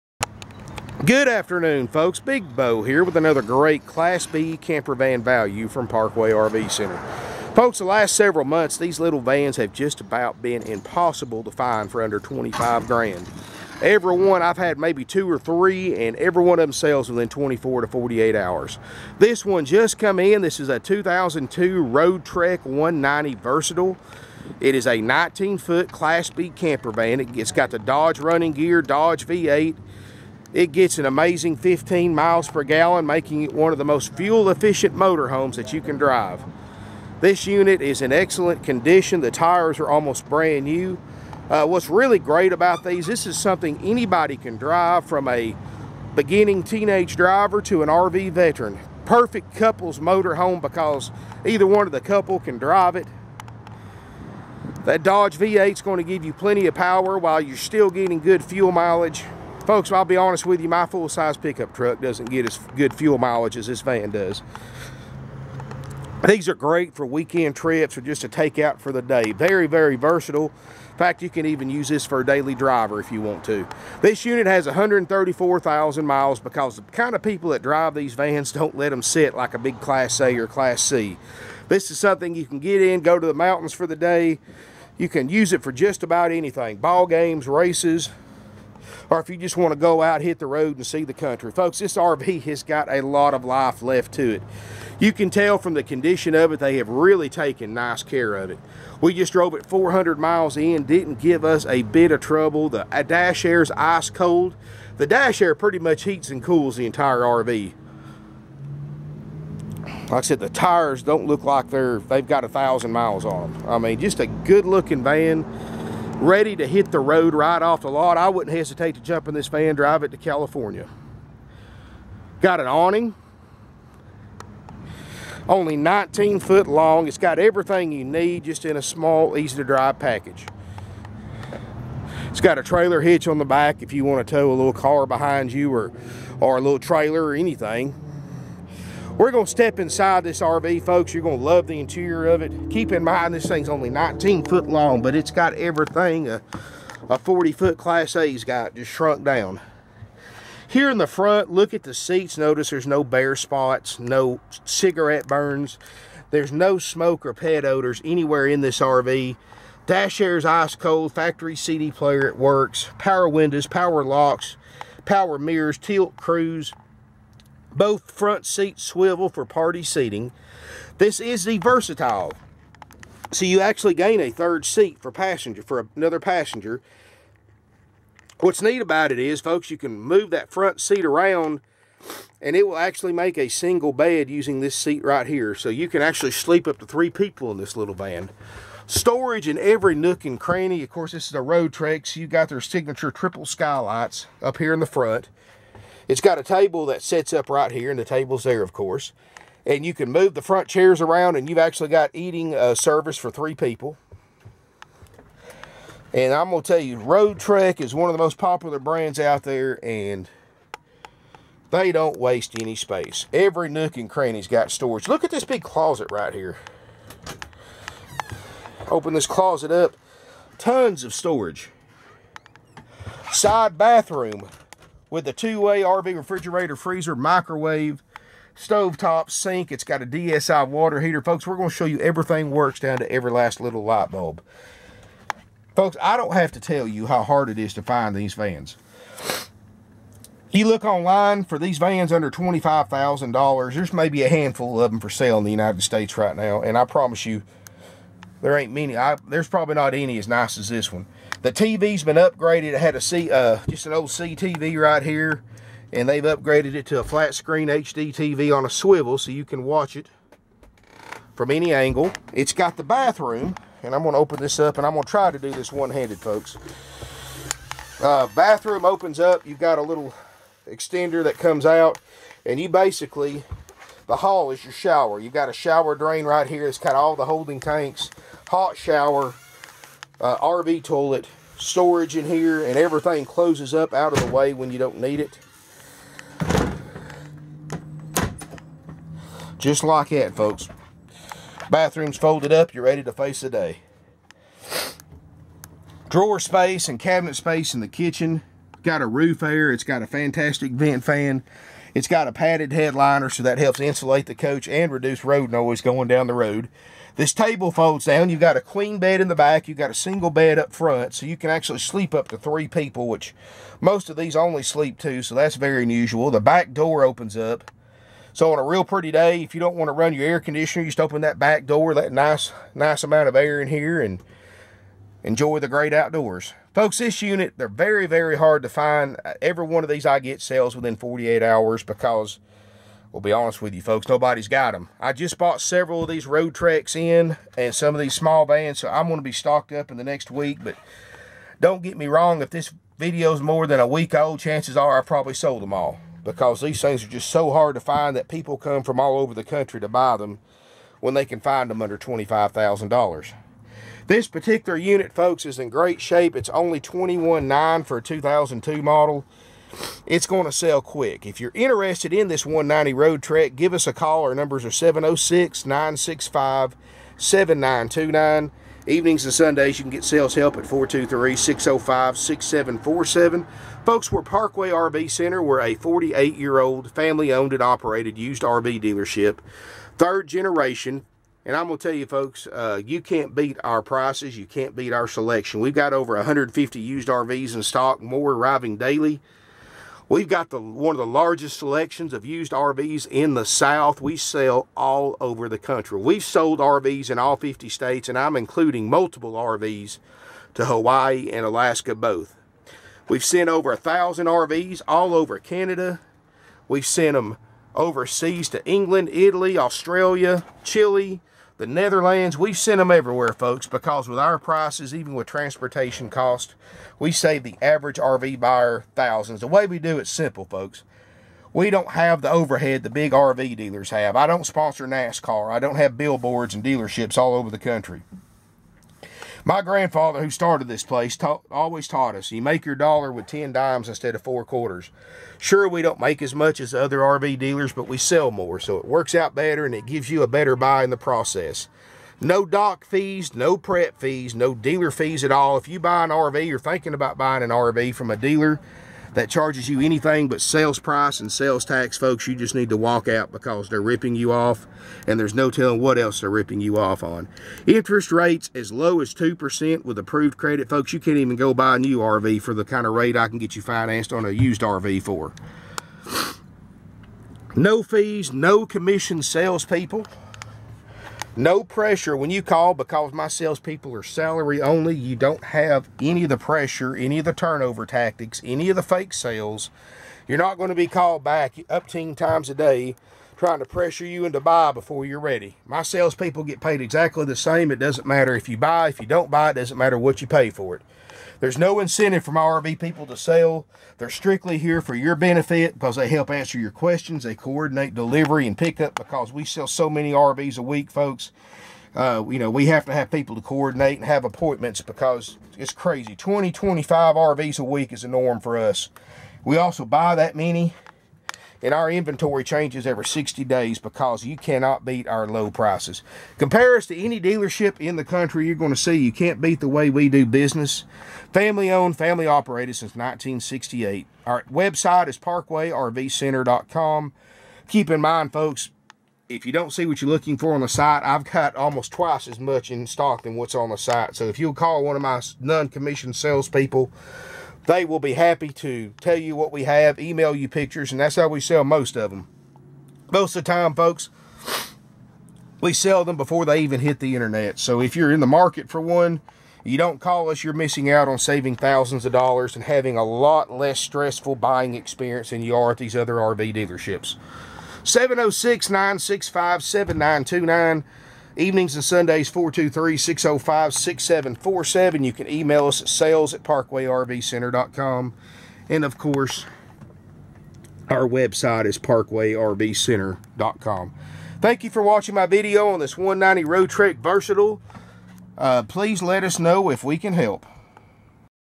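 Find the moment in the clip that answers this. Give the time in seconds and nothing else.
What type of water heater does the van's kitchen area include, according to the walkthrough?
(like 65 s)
230 s.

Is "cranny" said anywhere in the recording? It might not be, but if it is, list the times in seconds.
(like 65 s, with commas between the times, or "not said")
190 s, 214 s.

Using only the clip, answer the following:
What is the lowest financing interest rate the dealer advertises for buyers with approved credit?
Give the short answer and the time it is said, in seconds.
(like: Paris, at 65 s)
2%, at 459 s.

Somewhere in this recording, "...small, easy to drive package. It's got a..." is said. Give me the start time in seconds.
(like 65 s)
128 s.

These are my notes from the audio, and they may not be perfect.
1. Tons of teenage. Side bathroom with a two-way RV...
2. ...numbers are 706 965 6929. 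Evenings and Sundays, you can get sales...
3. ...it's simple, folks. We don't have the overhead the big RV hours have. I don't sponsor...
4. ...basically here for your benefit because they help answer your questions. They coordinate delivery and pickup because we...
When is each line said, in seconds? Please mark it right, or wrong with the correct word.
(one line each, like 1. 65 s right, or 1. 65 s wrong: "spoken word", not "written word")
1. 220 s wrong: "storage", not "teenage"
2. 364 s wrong: "7929", not "6929"
3. 419 s wrong: "dealers", not "hours"
4. 494 s wrong: "strictly", not "basically".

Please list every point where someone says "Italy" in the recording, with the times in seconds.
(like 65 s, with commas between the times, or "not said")
409 s.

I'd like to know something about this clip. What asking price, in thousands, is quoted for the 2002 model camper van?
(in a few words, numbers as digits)
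21.9.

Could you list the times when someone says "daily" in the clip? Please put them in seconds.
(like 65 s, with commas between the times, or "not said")
72 s, 388 s.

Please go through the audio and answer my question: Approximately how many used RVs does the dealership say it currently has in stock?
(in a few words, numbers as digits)
over 150.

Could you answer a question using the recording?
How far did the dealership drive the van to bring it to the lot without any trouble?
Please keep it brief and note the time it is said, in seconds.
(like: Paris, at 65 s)
400 miles, at 99 s.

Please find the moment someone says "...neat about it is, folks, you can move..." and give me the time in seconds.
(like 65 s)
178 s.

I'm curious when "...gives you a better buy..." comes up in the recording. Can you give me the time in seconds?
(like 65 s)
439 s.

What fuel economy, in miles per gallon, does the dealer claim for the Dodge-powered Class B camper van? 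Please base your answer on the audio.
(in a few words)
15.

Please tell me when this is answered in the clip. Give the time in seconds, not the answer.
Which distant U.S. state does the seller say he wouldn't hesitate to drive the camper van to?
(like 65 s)
120 s.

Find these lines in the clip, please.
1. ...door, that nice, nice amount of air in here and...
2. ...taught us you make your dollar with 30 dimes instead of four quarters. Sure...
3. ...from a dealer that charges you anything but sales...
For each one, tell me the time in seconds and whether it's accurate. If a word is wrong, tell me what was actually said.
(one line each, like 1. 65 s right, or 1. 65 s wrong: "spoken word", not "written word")
1. 321 s right
2. 431 s wrong: "10", not "30"
3. 447 s right.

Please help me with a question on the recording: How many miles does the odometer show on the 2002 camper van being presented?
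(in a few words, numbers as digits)
134,000.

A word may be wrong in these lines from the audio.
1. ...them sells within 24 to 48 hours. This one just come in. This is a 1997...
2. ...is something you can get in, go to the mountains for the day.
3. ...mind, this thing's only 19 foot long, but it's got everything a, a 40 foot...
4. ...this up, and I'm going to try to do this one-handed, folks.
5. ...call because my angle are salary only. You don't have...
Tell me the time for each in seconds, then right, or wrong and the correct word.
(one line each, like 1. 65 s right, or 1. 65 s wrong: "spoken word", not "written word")
1. 16 s wrong: "2002", not "1997"
2. 81 s right
3. 143 s right
4. 264 s right
5. 472 s wrong: "salespeople", not "angle".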